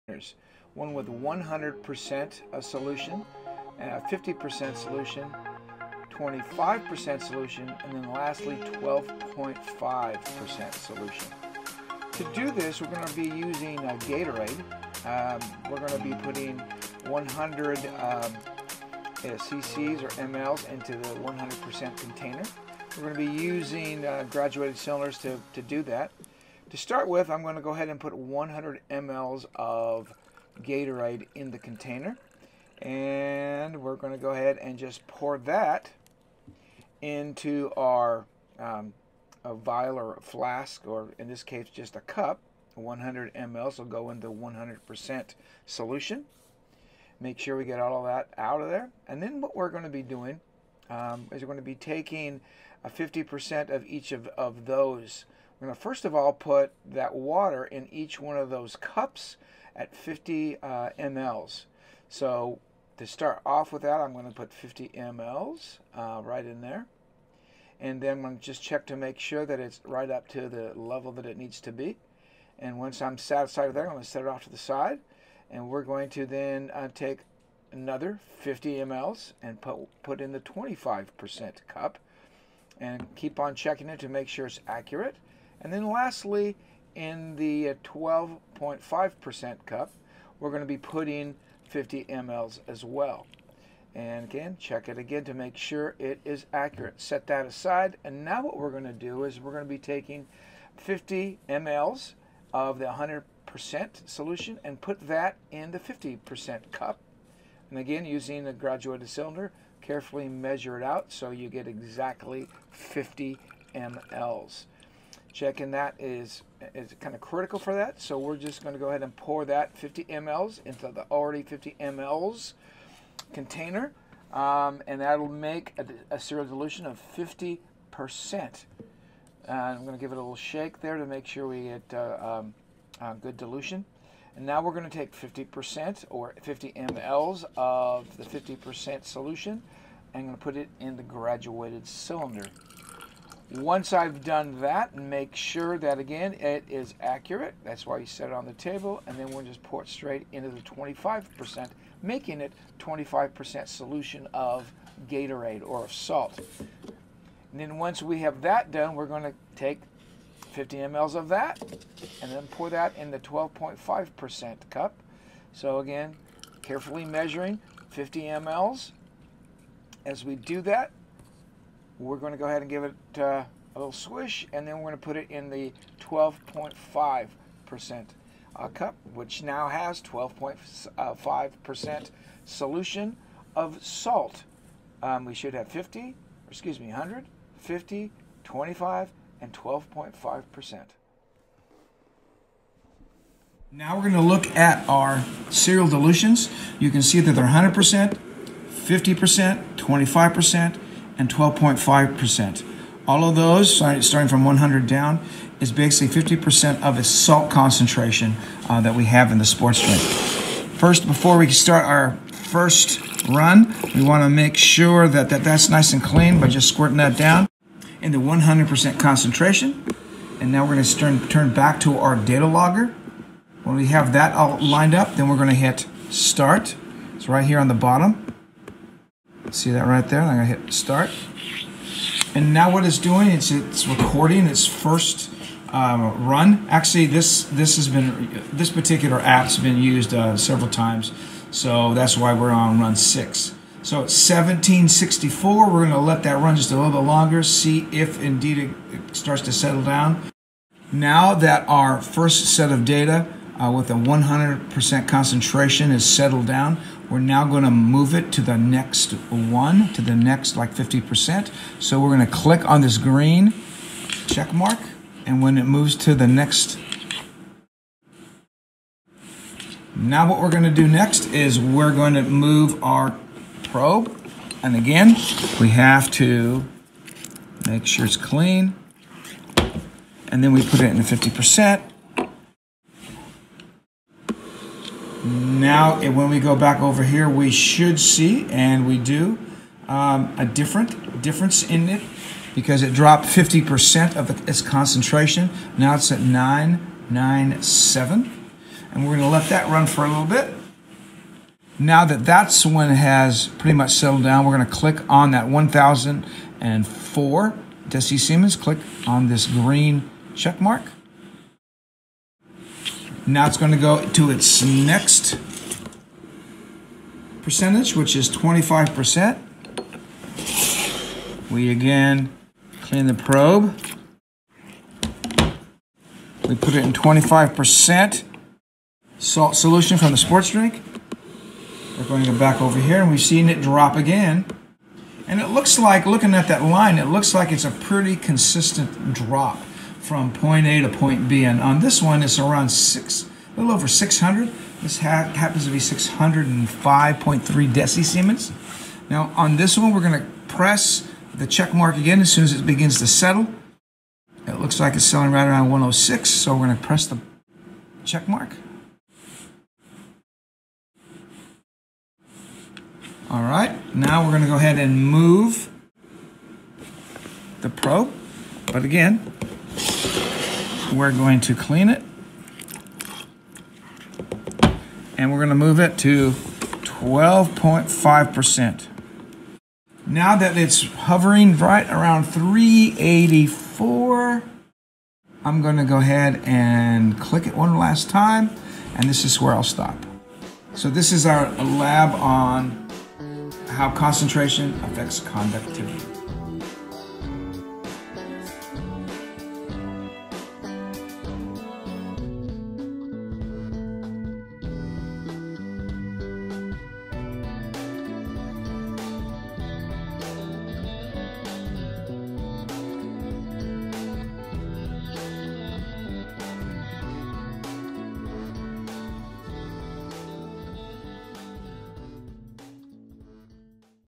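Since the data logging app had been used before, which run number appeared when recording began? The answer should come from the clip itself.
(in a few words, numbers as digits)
run 6.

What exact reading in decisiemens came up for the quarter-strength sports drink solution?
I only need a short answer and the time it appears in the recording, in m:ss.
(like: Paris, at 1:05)
605.3, at 5:45.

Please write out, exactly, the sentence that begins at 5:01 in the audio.
Now that that's when has pretty much settled down, we're going to click on that 1004 Deci Siemens.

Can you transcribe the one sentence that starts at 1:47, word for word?
And again, using a graduated cylinder, carefully measure it out so you get exactly 50 mLs.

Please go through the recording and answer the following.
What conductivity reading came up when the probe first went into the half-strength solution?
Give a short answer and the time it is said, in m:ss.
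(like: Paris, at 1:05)
997, at 4:56.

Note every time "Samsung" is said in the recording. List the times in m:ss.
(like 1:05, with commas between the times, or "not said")
not said.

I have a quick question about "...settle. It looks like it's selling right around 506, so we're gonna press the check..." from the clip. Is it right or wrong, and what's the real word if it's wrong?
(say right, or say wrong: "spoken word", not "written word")
wrong: "106", not "506".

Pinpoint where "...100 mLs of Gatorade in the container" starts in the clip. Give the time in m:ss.
0:28.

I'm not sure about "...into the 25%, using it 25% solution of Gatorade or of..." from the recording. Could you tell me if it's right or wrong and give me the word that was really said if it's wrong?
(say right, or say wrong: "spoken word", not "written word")
wrong: "making", not "using".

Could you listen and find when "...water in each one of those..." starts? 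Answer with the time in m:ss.
0:57.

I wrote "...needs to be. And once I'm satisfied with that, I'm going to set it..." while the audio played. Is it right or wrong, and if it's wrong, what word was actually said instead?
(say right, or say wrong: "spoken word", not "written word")
right.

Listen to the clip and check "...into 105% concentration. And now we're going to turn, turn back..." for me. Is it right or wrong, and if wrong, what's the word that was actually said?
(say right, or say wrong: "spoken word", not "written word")
wrong: "100", not "105".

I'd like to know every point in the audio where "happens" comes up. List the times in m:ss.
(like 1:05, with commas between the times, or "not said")
5:44.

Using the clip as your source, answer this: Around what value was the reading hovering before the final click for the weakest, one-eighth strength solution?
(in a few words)
384.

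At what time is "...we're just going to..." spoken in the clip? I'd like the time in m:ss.
1:58.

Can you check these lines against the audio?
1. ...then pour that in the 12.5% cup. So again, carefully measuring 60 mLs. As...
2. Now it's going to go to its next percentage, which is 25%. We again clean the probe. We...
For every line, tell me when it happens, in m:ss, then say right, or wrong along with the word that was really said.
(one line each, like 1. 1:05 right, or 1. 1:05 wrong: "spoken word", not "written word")
1. 2:42 wrong: "50", not "60"
2. 5:13 right.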